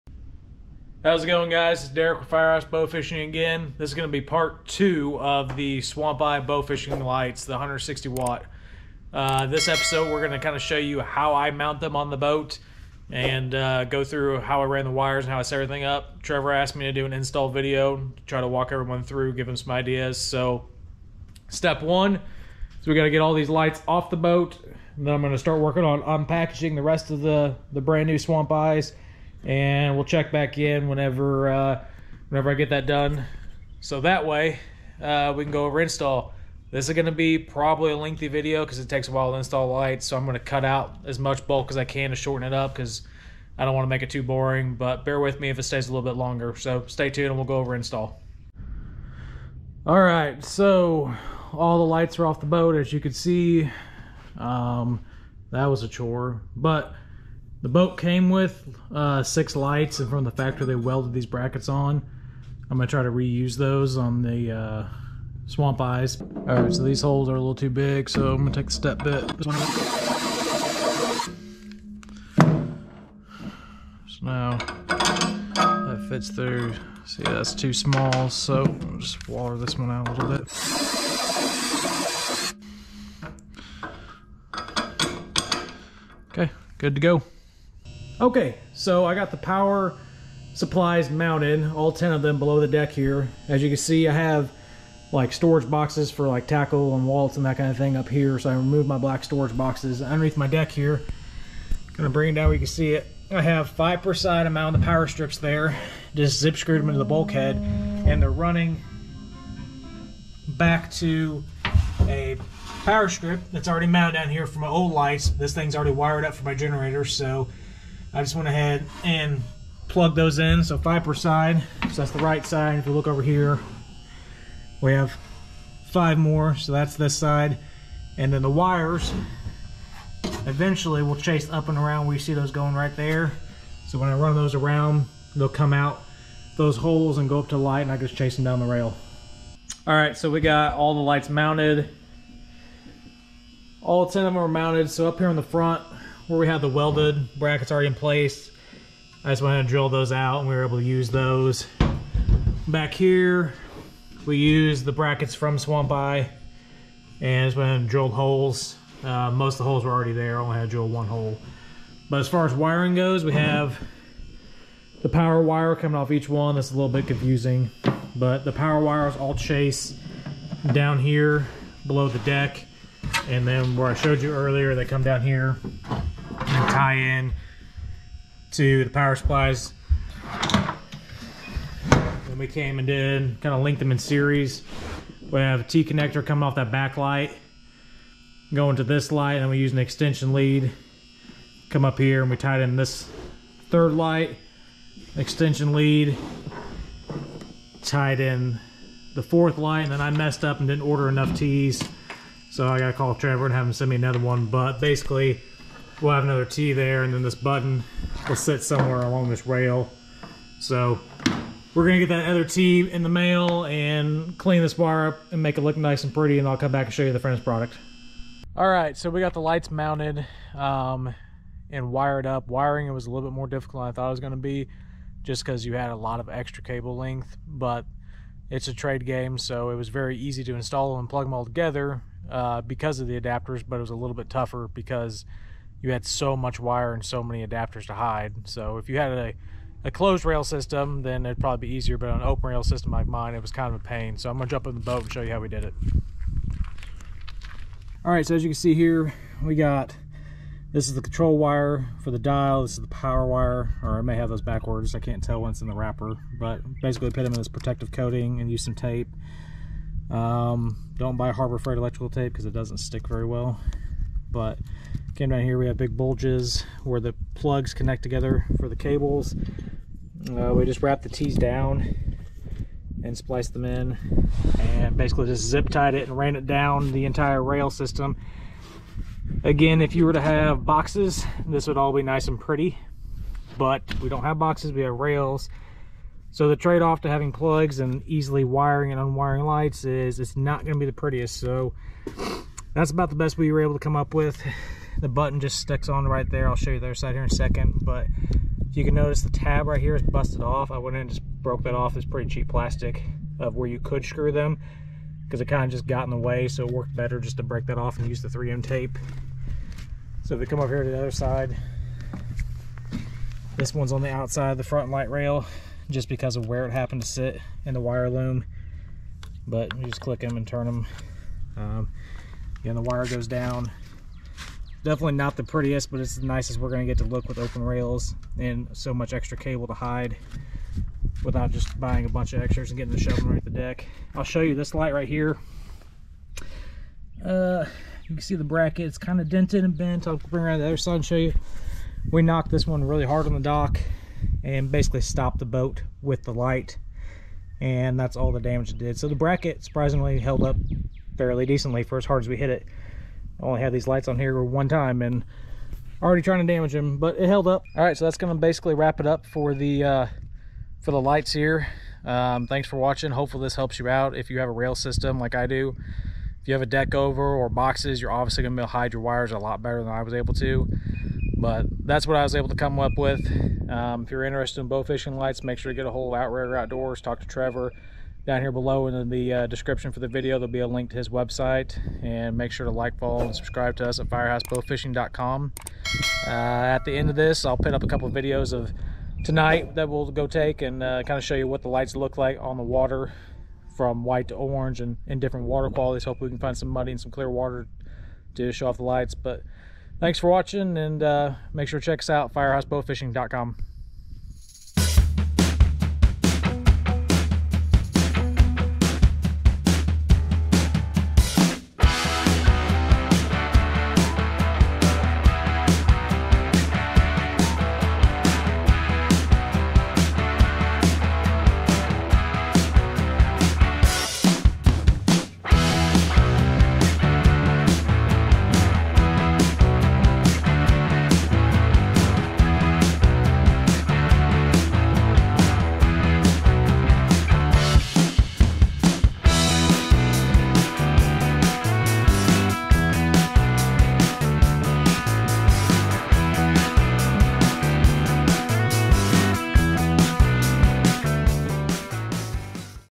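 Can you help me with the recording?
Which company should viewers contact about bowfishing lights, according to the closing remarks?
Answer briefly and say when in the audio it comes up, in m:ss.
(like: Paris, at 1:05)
Outrigger Outdoors, at 6:16.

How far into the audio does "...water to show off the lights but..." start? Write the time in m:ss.
6:37.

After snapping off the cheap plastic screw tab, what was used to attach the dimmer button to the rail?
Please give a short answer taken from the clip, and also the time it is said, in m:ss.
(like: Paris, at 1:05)
3M tape, at 5:08.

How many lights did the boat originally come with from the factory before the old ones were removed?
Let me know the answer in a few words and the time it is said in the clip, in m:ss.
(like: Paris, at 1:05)
6, at 0:59.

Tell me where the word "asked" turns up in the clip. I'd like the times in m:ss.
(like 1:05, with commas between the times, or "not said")
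0:16.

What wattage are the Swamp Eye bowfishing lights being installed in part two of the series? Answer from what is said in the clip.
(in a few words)
160 watt.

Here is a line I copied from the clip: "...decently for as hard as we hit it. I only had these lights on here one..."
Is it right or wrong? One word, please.
right.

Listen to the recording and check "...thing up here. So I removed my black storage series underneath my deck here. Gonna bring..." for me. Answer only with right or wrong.
wrong.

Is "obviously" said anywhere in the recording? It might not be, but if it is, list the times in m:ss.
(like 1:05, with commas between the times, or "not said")
6:08.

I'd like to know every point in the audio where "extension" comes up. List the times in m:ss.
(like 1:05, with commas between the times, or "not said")
3:09, 3:15.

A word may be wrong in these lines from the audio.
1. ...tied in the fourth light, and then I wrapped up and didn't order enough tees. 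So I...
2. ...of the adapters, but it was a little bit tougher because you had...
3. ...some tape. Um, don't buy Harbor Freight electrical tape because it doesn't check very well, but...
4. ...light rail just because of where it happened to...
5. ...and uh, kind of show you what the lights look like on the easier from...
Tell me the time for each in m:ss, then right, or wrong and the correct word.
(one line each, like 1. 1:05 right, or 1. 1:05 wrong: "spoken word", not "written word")
1. 3:17 wrong: "messed", not "wrapped"
2. 3:52 right
3. 4:18 wrong: "stick", not "check"
4. 5:14 right
5. 6:30 wrong: "water", not "easier".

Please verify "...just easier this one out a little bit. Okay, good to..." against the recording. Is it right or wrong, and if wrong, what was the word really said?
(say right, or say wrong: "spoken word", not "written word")
wrong: "water", not "easier".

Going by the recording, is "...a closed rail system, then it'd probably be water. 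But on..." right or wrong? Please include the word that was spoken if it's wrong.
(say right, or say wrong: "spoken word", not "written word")
wrong: "easier", not "water".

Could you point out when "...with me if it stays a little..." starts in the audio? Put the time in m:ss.
0:45.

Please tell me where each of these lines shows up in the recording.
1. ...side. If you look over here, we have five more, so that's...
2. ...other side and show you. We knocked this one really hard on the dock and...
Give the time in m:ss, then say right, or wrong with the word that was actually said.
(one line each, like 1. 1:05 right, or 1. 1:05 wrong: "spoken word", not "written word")
1. 2:02 right
2. 5:40 right.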